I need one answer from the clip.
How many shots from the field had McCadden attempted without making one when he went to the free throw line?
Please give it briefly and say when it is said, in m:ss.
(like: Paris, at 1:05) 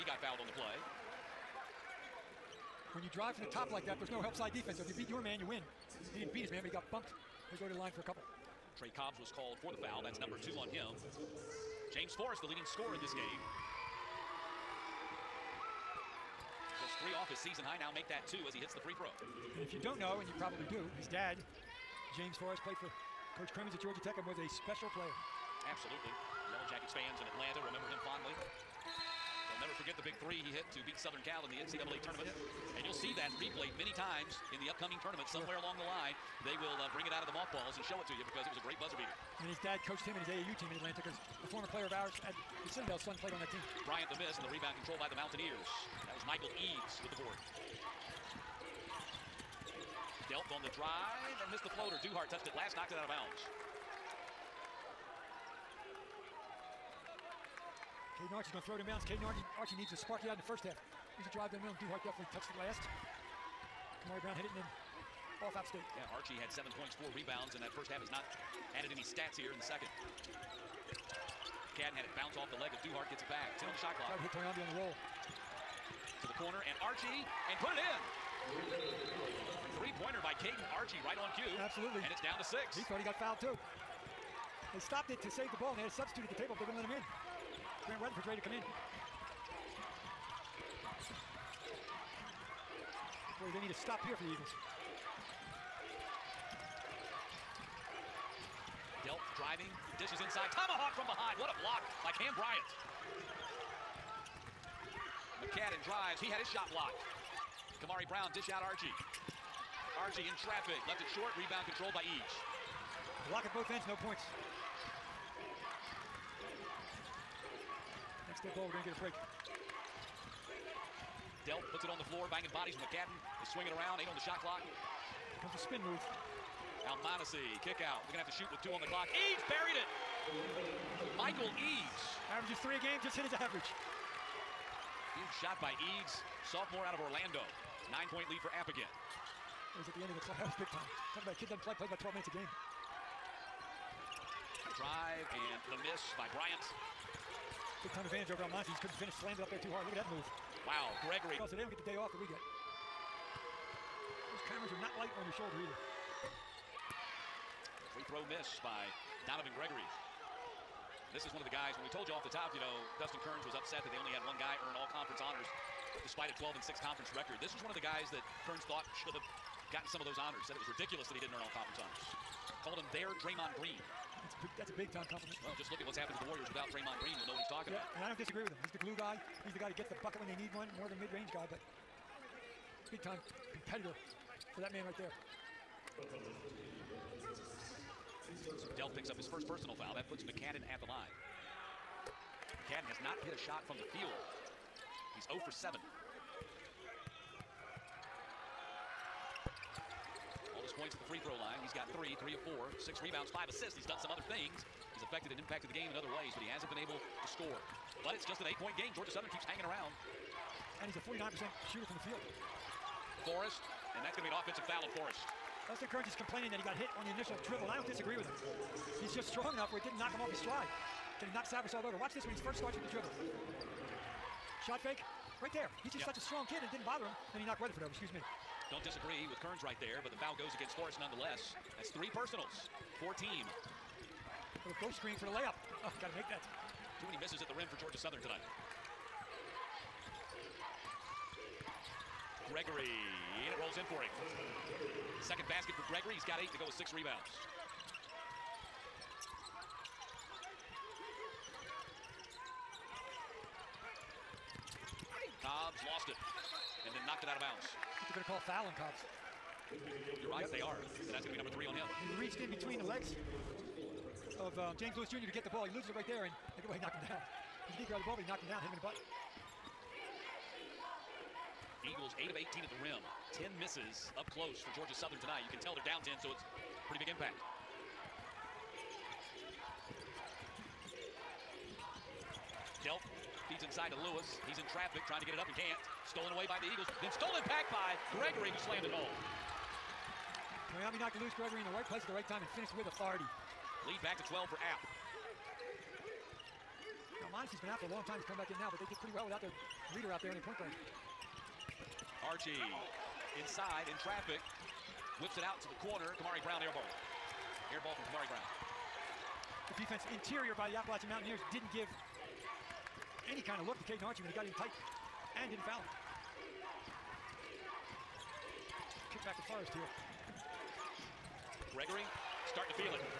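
7, at 3:15.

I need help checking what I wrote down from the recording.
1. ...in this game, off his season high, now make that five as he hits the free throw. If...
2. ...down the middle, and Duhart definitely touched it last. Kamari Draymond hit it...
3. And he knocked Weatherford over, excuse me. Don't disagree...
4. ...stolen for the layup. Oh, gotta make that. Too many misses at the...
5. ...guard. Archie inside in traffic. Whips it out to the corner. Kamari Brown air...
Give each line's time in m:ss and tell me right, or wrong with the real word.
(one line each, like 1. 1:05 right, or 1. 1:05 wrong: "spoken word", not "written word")
1. 0:12 wrong: "two", not "five"
2. 1:01 wrong: "Brown", not "Draymond"
3. 3:47 right
4. 3:54 wrong: "screen", not "stolen"
5. 5:00 right.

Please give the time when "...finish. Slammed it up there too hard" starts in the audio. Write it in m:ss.
2:28.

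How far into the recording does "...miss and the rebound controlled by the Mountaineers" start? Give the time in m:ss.
0:44.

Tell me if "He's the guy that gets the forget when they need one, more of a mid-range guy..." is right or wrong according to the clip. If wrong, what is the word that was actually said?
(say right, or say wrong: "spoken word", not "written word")
wrong: "bucket", not "forget".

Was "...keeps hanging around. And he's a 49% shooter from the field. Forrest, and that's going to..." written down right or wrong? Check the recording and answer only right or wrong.
right.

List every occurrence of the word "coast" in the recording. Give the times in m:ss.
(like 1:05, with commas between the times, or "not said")
not said.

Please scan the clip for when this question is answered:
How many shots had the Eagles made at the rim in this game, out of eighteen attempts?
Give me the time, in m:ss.
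4:32.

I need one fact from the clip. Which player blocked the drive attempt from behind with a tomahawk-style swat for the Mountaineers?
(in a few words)
Cam Bryant.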